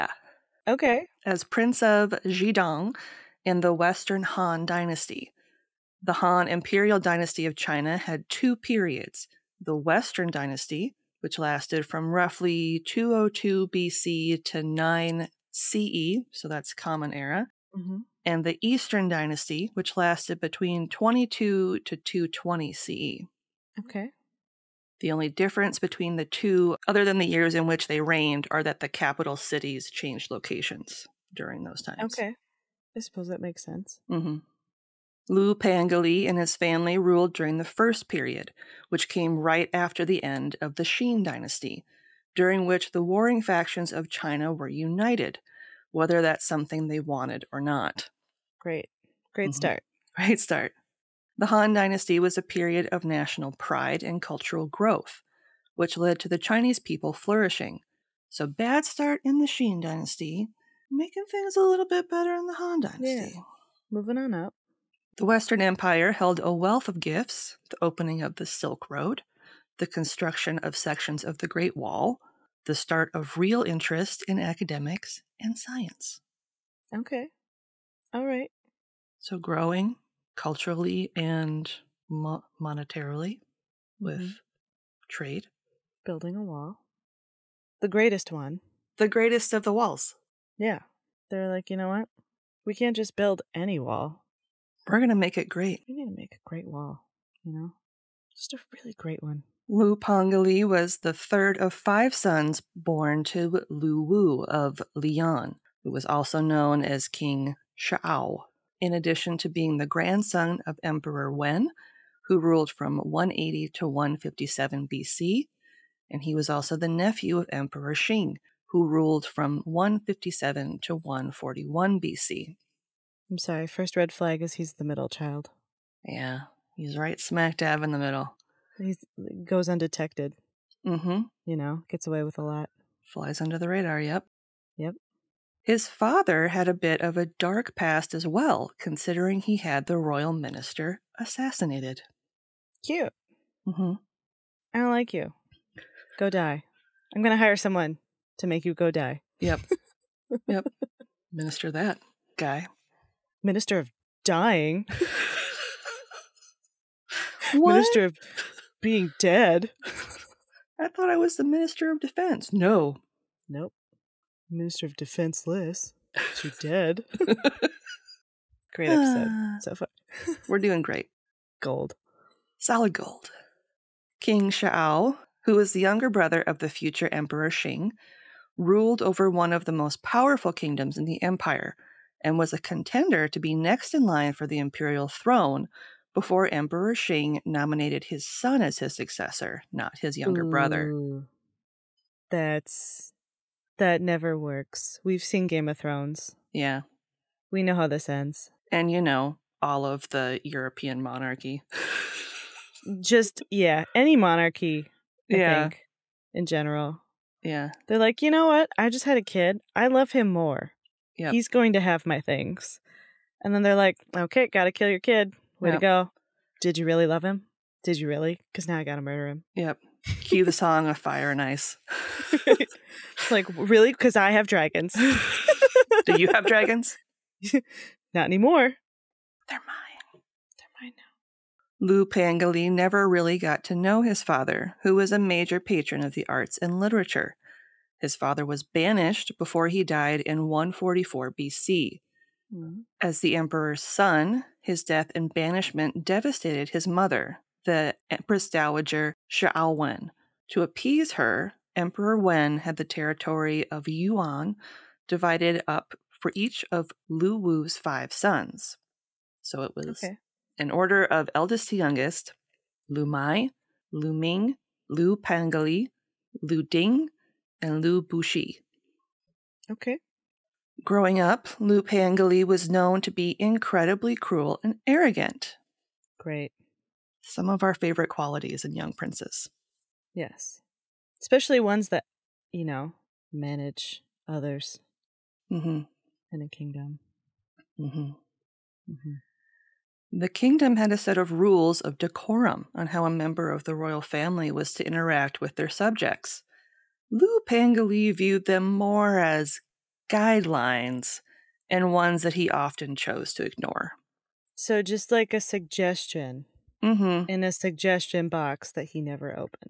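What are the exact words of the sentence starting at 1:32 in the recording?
We can't just build any wall.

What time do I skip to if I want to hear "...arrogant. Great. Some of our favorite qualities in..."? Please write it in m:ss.
4:34.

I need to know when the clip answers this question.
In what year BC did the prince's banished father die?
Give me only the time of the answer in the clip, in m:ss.
4:00.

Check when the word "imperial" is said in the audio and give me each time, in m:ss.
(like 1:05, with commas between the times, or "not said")
0:06, 3:04.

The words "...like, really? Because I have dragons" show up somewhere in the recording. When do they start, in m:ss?
3:43.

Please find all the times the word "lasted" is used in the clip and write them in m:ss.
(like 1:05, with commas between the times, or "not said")
0:11, 0:19.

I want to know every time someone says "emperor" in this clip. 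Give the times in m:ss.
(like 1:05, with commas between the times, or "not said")
1:50, 1:57, 2:57, 3:06, 4:03, 4:11.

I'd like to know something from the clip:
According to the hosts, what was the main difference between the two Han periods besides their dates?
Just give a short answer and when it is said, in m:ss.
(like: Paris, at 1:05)
Capital cities changed locations, at 0:28.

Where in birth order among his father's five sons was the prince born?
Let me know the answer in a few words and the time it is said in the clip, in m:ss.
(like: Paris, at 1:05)
Third, at 1:41.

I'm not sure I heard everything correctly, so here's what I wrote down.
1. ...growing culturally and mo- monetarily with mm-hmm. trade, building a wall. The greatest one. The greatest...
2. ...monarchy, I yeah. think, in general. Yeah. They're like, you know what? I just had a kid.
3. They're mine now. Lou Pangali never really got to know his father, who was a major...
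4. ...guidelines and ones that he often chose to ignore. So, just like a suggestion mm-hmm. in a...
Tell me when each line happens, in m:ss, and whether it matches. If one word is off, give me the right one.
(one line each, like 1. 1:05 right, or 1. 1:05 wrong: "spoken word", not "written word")
1. 1:19 right
2. 3:24 right
3. 3:50 right
4. 5:00 right.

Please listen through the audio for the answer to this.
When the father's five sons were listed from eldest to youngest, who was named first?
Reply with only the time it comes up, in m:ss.
4:22.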